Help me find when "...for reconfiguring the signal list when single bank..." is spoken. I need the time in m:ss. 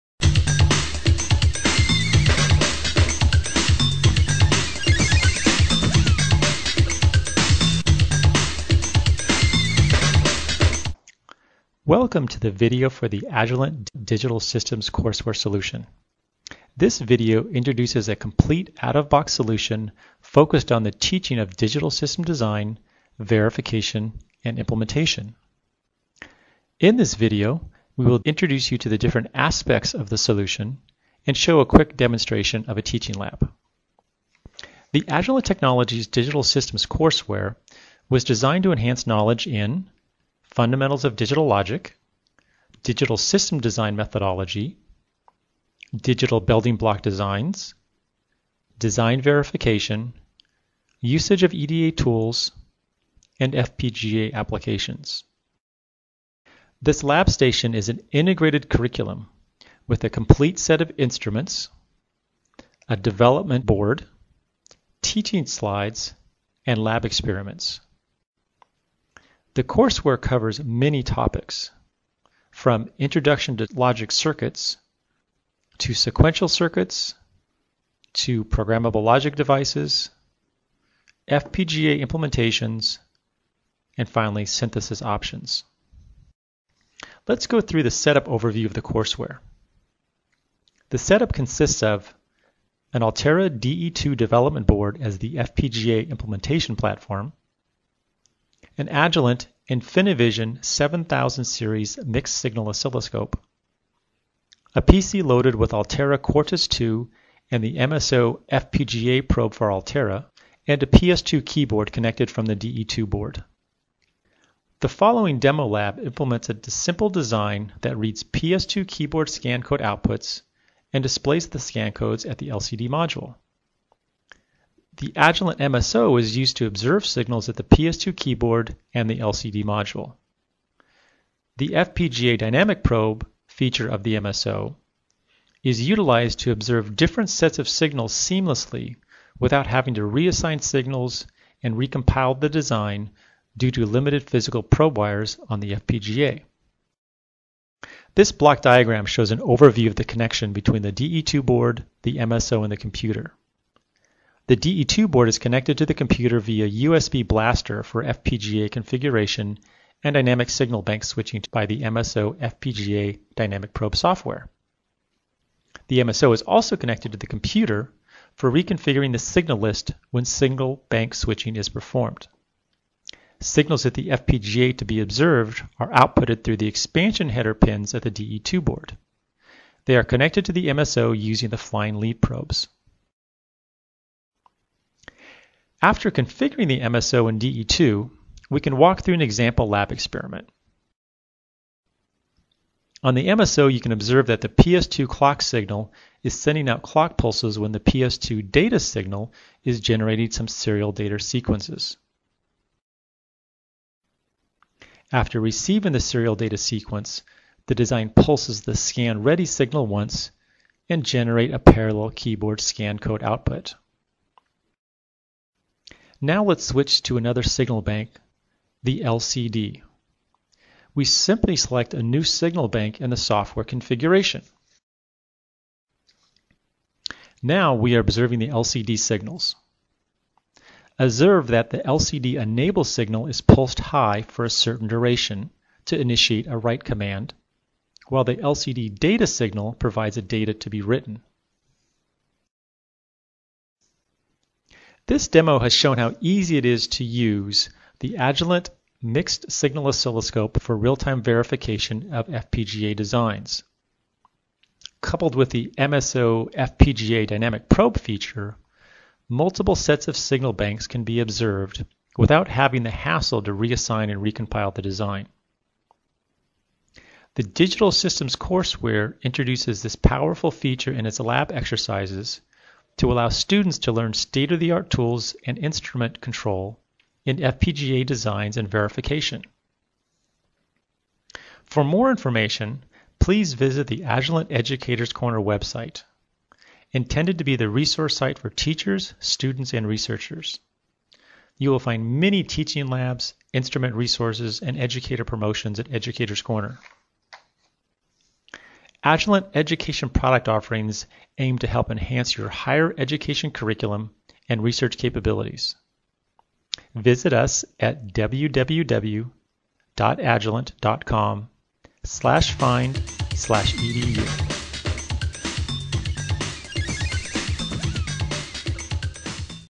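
2:48.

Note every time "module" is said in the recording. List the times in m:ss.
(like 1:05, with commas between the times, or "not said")
2:02, 2:09.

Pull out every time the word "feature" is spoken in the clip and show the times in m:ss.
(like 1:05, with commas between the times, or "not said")
2:13, 4:17, 4:30.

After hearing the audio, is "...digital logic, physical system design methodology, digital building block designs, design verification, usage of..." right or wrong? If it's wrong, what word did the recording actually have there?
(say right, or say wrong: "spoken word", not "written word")
wrong: "digital", not "physical".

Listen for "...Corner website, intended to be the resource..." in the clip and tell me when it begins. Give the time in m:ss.
4:45.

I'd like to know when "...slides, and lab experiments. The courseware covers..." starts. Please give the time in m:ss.
1:05.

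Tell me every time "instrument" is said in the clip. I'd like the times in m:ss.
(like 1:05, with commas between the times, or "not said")
1:00, 4:35, 4:53.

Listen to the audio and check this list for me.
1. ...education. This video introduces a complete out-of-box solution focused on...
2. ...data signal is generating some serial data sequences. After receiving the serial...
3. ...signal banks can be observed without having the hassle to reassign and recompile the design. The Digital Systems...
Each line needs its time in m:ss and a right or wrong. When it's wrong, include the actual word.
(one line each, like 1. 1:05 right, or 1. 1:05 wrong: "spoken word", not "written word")
1. 0:15 wrong: "solution", not "education"
2. 3:18 right
3. 4:20 right.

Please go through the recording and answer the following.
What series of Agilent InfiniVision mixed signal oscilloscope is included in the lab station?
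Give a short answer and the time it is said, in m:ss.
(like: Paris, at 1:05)
7000 series, at 1:40.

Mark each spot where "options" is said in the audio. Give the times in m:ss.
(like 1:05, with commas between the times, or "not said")
1:25.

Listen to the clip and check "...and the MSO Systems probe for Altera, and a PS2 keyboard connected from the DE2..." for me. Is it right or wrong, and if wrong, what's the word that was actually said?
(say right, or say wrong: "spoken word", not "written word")
wrong: "FPGA", not "Systems".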